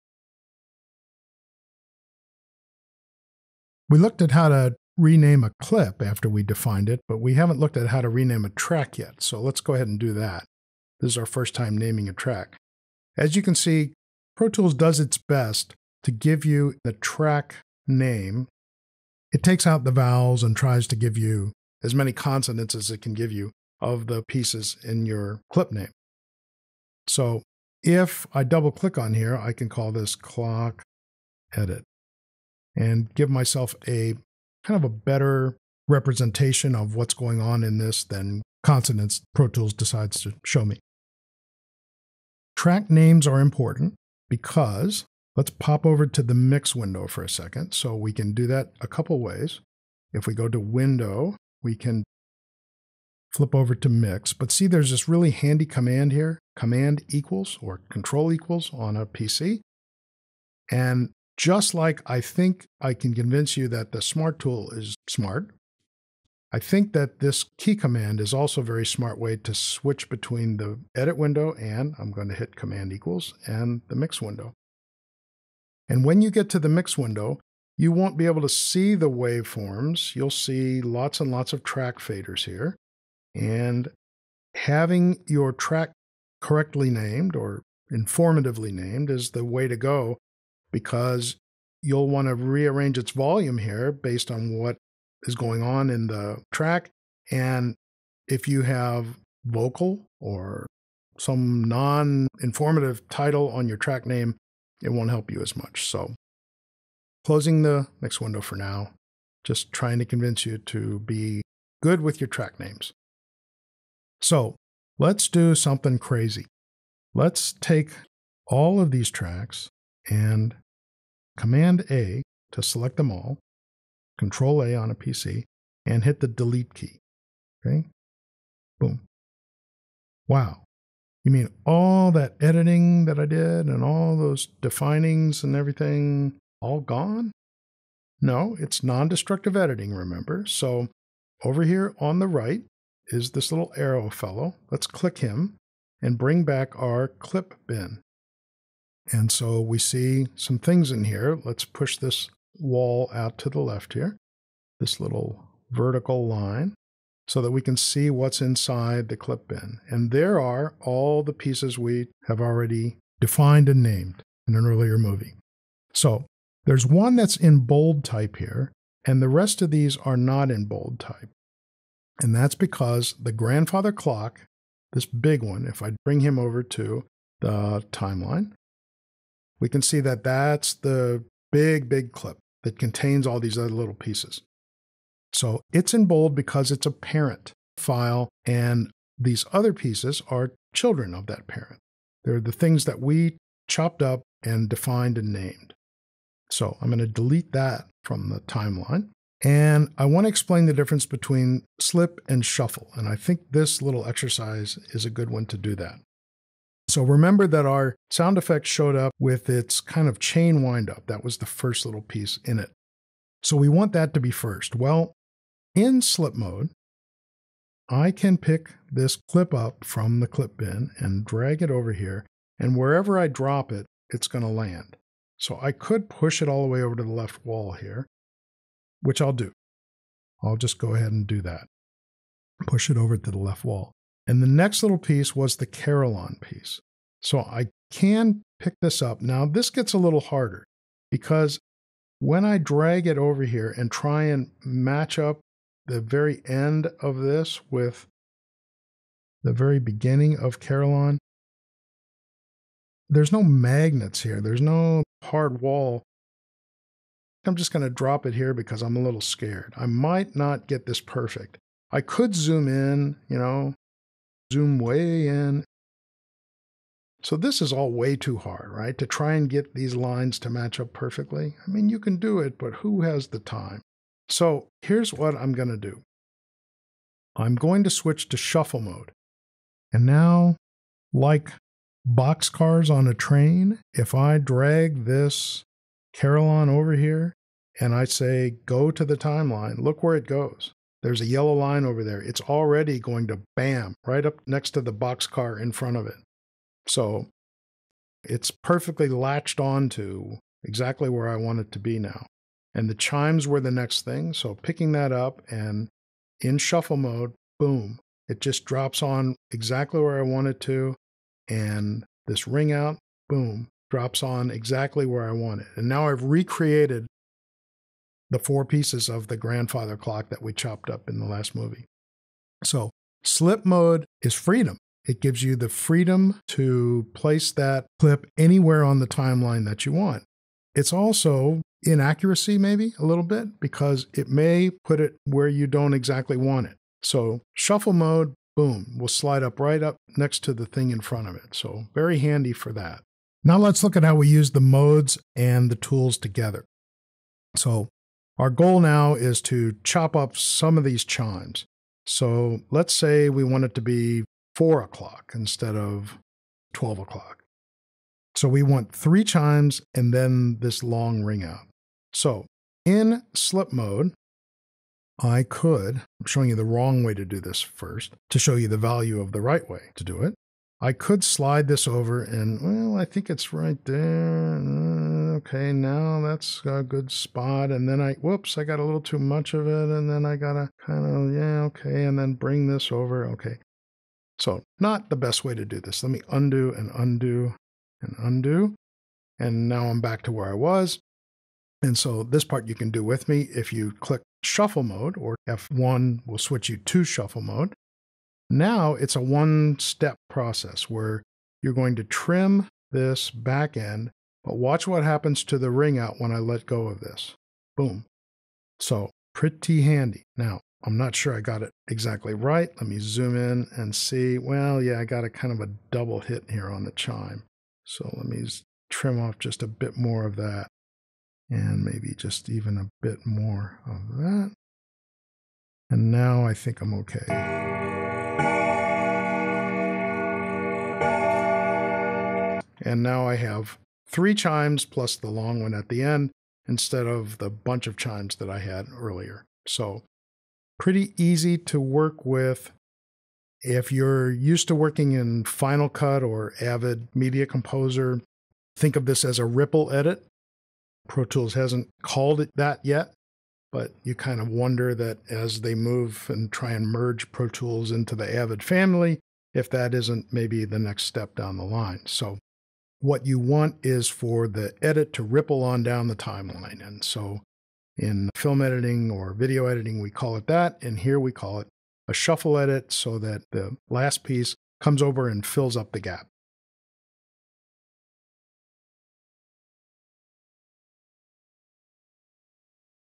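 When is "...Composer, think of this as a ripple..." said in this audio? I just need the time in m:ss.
7:27.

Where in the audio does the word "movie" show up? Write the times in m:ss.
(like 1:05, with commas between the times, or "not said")
2:44, 5:21.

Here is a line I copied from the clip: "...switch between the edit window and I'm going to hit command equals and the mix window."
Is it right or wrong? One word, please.
right.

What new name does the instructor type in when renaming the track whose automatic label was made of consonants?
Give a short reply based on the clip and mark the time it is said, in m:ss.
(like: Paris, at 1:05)
clock edit, at 0:30.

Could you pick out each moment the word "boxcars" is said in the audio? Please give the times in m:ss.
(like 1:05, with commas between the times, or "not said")
4:42, 4:54.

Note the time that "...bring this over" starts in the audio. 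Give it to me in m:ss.
6:22.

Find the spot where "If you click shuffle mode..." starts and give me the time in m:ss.
6:33.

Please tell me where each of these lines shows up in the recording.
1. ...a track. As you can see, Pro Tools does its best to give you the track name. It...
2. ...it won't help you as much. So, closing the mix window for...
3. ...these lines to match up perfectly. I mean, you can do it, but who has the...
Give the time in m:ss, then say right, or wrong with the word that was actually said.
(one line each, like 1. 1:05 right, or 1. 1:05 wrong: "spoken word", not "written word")
1. 0:12 right
2. 1:44 right
3. 4:29 right.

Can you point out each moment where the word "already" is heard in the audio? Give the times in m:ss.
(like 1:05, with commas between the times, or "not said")
2:42, 4:52.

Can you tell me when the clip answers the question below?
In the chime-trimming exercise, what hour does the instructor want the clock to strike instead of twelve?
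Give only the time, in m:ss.
5:54.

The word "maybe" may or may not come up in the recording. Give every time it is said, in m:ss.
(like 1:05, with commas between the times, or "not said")
5:32, 7:01, 7:40.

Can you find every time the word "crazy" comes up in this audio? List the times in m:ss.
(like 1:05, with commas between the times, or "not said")
1:55.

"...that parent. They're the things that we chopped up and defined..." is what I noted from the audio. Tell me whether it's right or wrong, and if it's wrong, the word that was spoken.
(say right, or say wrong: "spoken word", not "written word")
right.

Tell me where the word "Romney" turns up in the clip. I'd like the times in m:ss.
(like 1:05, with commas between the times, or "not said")
not said.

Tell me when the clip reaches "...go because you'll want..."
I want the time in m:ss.
1:29.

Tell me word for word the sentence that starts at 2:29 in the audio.
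And so we see some things in here.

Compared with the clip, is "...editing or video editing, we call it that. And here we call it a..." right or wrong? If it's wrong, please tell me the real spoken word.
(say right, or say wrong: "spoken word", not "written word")
right.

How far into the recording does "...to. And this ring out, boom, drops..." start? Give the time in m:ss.
5:10.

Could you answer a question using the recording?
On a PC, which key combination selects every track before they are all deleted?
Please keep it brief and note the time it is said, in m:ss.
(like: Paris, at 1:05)
Control A, at 2:04.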